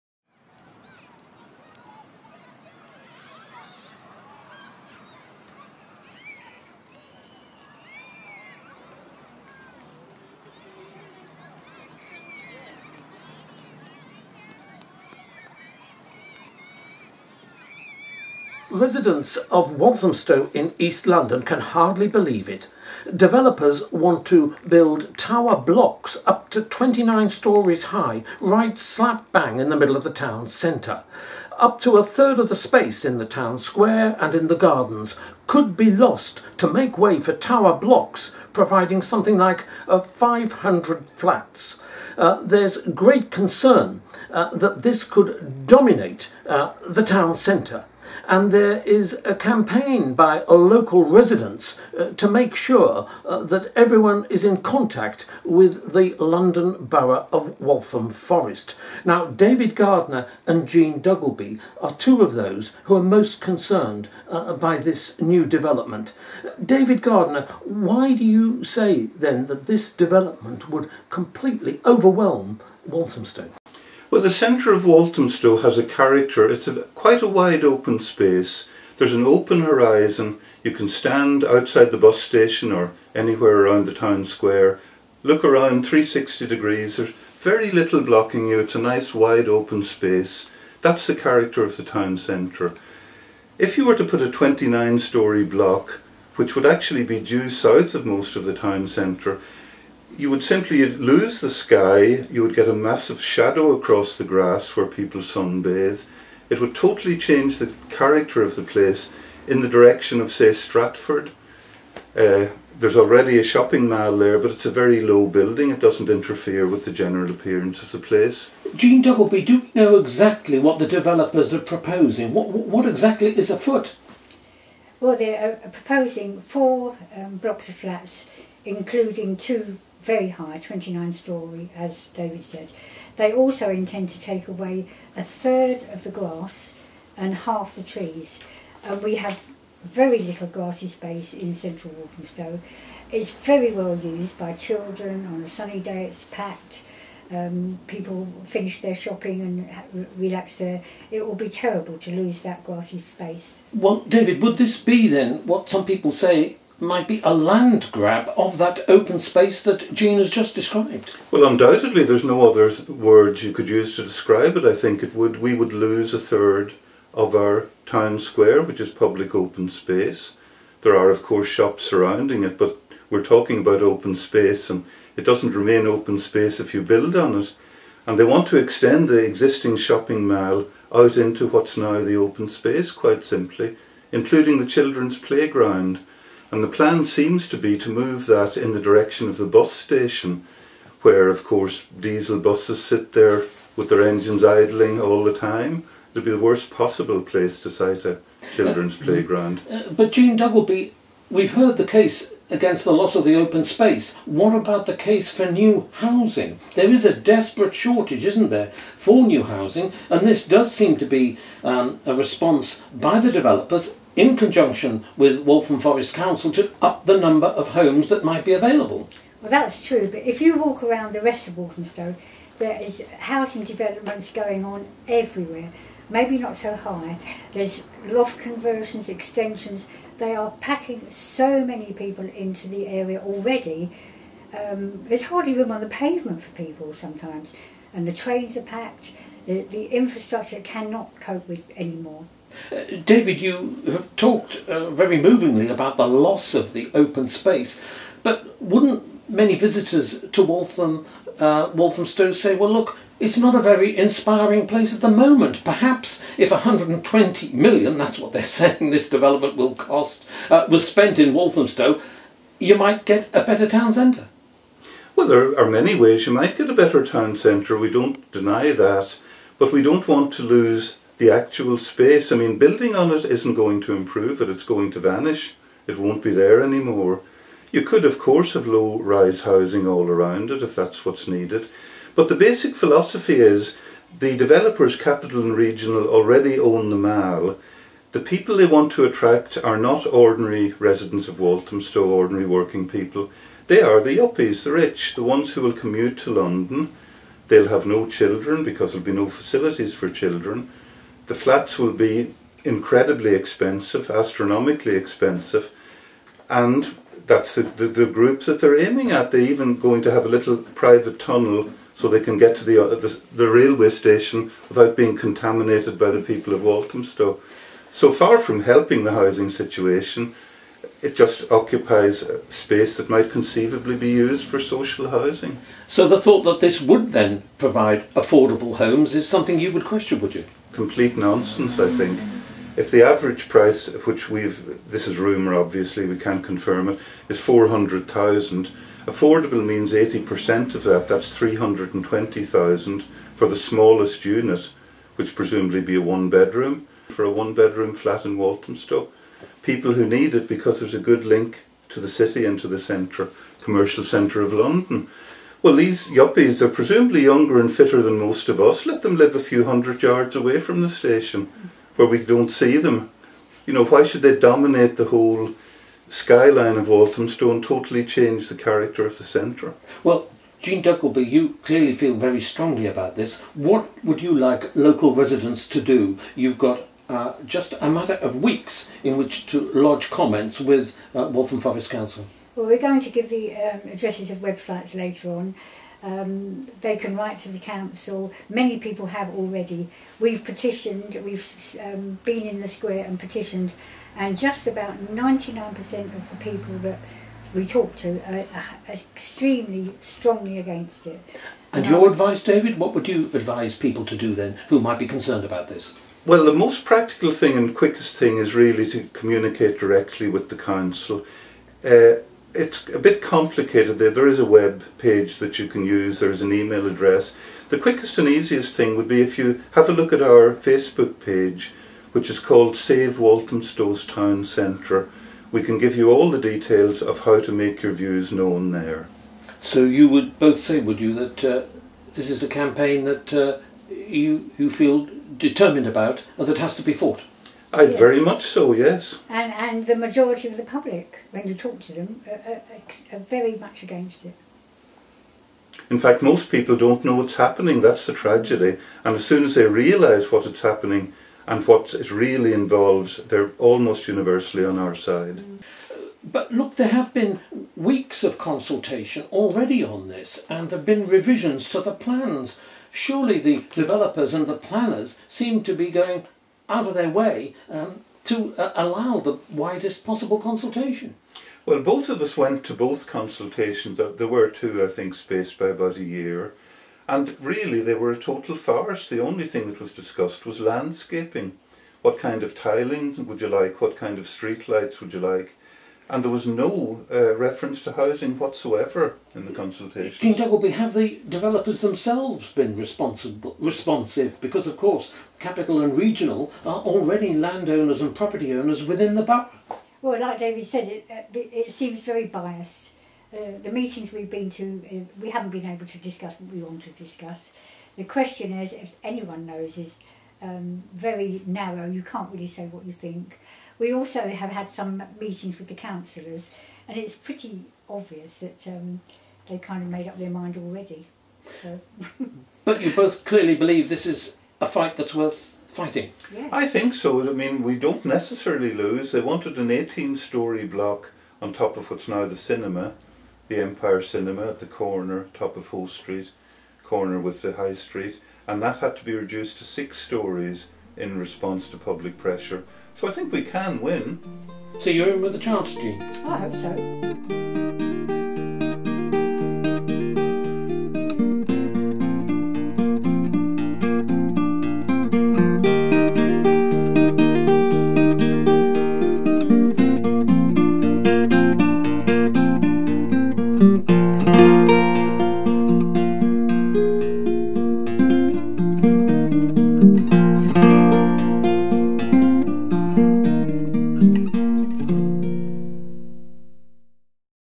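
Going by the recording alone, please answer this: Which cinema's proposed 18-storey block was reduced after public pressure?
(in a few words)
Empire Cinema.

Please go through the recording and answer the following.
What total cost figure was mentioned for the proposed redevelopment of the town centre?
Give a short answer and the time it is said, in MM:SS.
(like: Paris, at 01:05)
£120 million, at 04:16.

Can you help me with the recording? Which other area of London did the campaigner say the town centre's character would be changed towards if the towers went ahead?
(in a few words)
Stratford.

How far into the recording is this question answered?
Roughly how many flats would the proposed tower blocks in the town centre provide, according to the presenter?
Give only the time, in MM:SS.
00:39.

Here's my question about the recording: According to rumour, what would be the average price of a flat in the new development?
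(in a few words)
£400,000.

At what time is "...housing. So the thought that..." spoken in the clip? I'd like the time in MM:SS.
05:25.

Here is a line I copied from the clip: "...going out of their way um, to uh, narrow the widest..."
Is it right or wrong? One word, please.
wrong.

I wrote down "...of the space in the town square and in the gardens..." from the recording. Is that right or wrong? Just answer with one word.
right.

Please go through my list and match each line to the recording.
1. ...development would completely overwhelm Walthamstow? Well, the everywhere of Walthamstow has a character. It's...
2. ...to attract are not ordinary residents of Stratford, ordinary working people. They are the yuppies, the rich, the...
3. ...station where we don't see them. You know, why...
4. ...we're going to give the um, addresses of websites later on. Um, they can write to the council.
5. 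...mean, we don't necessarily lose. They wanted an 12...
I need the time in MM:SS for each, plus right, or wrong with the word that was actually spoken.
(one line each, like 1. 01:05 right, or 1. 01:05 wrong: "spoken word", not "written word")
1. 01:09 wrong: "centre", not "everywhere"
2. 04:48 wrong: "Walthamstow", not "Stratford"
3. 06:00 right
4. 06:22 right
5. 08:47 wrong: "18", not "12".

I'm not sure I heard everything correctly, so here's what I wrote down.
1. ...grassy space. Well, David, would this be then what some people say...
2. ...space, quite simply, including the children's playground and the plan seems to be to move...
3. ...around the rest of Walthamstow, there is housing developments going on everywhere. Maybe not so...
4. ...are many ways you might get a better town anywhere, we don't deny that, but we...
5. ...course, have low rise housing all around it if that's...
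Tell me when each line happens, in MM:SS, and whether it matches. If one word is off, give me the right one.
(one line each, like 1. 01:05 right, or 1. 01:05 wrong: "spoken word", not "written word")
1. 02:32 right
2. 03:02 right
3. 03:40 right
4. 04:25 wrong: "centre", not "anywhere"
5. 04:38 right.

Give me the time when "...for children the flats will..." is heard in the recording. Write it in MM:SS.
04:59.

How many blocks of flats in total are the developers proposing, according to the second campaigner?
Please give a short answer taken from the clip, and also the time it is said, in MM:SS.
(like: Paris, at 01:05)
4, at 02:06.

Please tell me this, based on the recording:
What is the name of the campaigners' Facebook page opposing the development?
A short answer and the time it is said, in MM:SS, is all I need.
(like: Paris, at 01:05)
Save Walthamstow's Town Centre, at 07:02.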